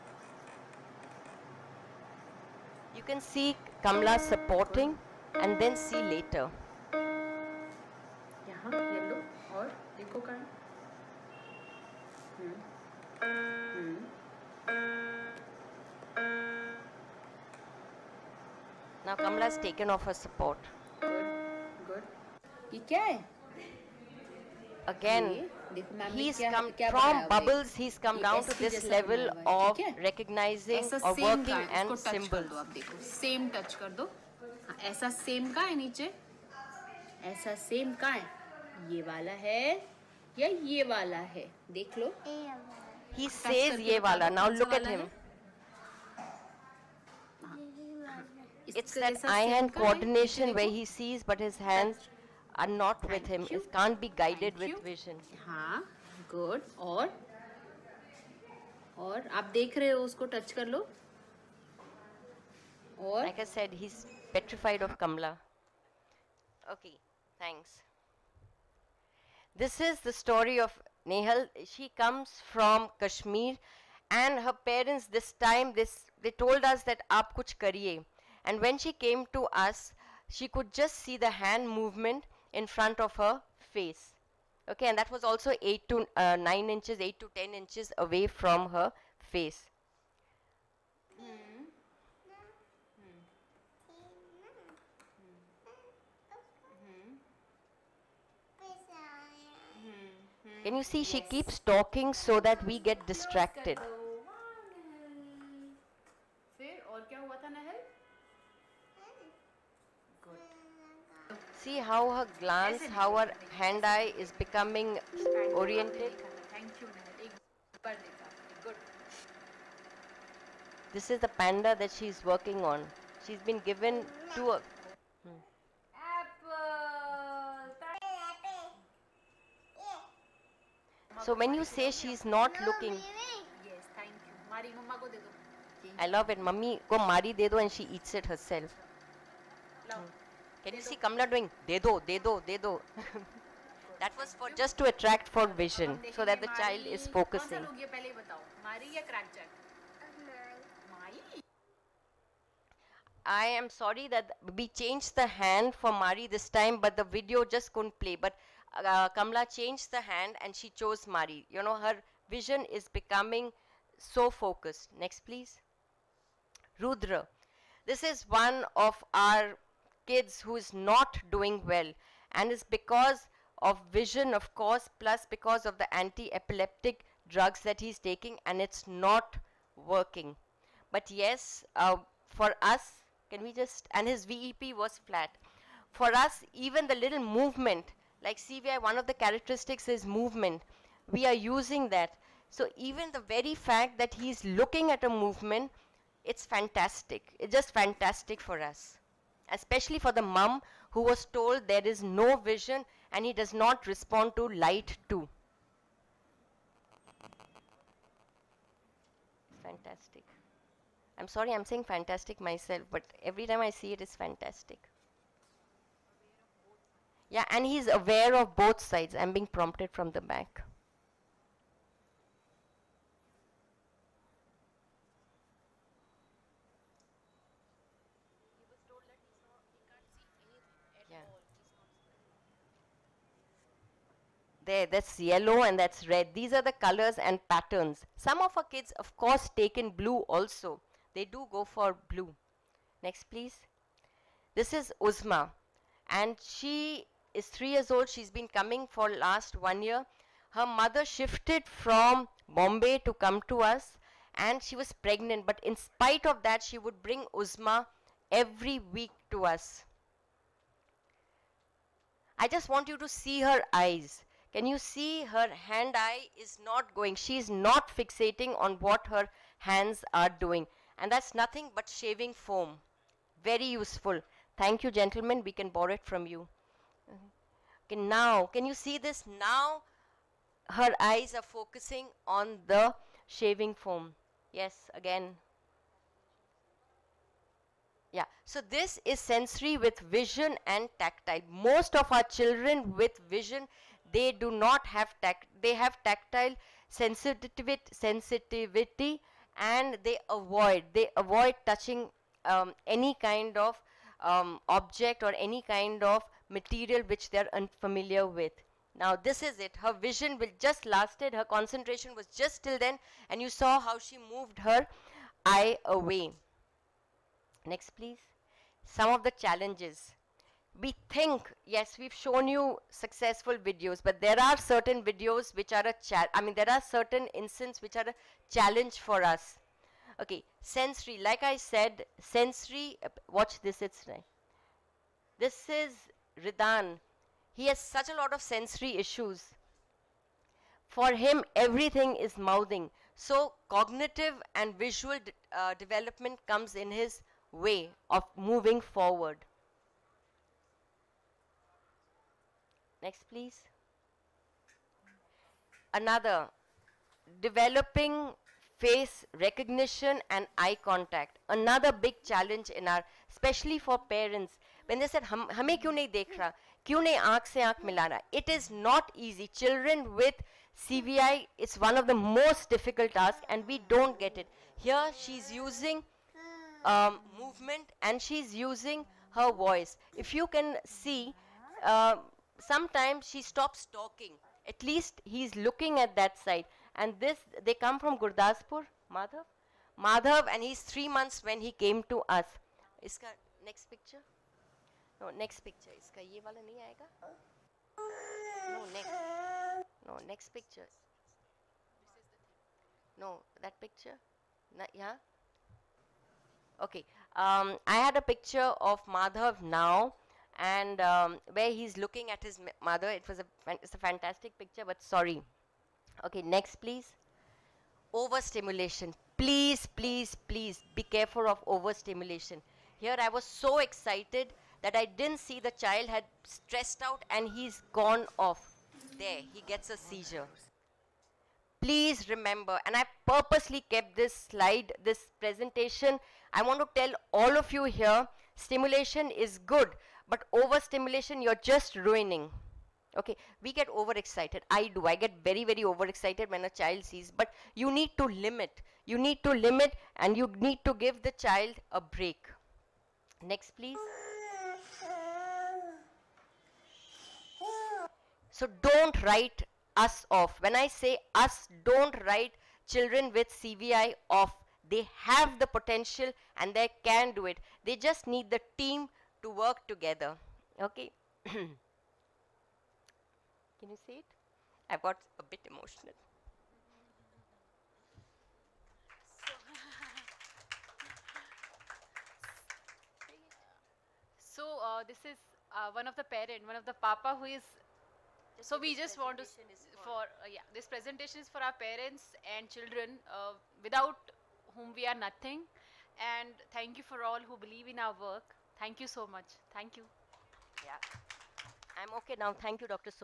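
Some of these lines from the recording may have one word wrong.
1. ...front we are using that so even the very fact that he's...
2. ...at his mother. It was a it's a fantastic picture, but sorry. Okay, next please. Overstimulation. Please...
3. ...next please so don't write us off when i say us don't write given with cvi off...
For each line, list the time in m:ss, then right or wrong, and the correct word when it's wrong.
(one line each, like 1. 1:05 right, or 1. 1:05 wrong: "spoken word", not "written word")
1. 3:10 wrong: "movement", not "front"
2. 6:52 right
3. 7:33 wrong: "children", not "given".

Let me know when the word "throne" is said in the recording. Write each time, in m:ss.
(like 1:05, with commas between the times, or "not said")
not said.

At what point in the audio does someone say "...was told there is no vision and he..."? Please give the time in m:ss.
3:21.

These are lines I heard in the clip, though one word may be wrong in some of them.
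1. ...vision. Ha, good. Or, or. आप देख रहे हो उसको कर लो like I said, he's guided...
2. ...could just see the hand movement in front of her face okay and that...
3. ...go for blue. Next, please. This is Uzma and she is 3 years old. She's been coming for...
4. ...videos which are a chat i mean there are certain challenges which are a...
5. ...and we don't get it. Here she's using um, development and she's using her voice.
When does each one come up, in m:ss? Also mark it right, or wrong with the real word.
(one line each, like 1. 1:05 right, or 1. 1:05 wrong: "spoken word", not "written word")
1. 0:54 wrong: "petrified", not "guided"
2. 1:20 right
3. 4:01 right
4. 5:25 wrong: "instances", not "challenges"
5. 6:13 wrong: "movement", not "development".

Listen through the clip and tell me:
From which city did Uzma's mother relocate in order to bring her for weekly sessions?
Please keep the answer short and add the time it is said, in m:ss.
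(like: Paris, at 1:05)
Bombay, at 4:12.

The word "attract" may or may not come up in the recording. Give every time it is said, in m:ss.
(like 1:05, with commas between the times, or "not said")
2:24.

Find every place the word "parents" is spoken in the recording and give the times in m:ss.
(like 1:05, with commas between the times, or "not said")
1:14, 6:03, 8:06, 8:11.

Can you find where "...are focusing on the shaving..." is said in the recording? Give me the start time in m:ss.
4:41.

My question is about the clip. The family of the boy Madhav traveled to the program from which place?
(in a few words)
Gurdaspur.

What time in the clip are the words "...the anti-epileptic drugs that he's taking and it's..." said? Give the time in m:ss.
2:55.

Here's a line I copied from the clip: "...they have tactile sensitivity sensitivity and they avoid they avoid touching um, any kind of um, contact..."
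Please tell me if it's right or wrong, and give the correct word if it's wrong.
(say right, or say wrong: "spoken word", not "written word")
wrong: "object", not "contact".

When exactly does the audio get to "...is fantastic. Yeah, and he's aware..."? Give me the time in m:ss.
3:34.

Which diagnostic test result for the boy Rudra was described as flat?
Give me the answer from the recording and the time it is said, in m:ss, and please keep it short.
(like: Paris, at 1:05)
VEP, at 3:04.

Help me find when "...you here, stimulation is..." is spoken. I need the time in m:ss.
7:17.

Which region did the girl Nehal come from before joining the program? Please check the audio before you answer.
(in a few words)
Kashmir.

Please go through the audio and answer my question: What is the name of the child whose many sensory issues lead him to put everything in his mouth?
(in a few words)
Ridan.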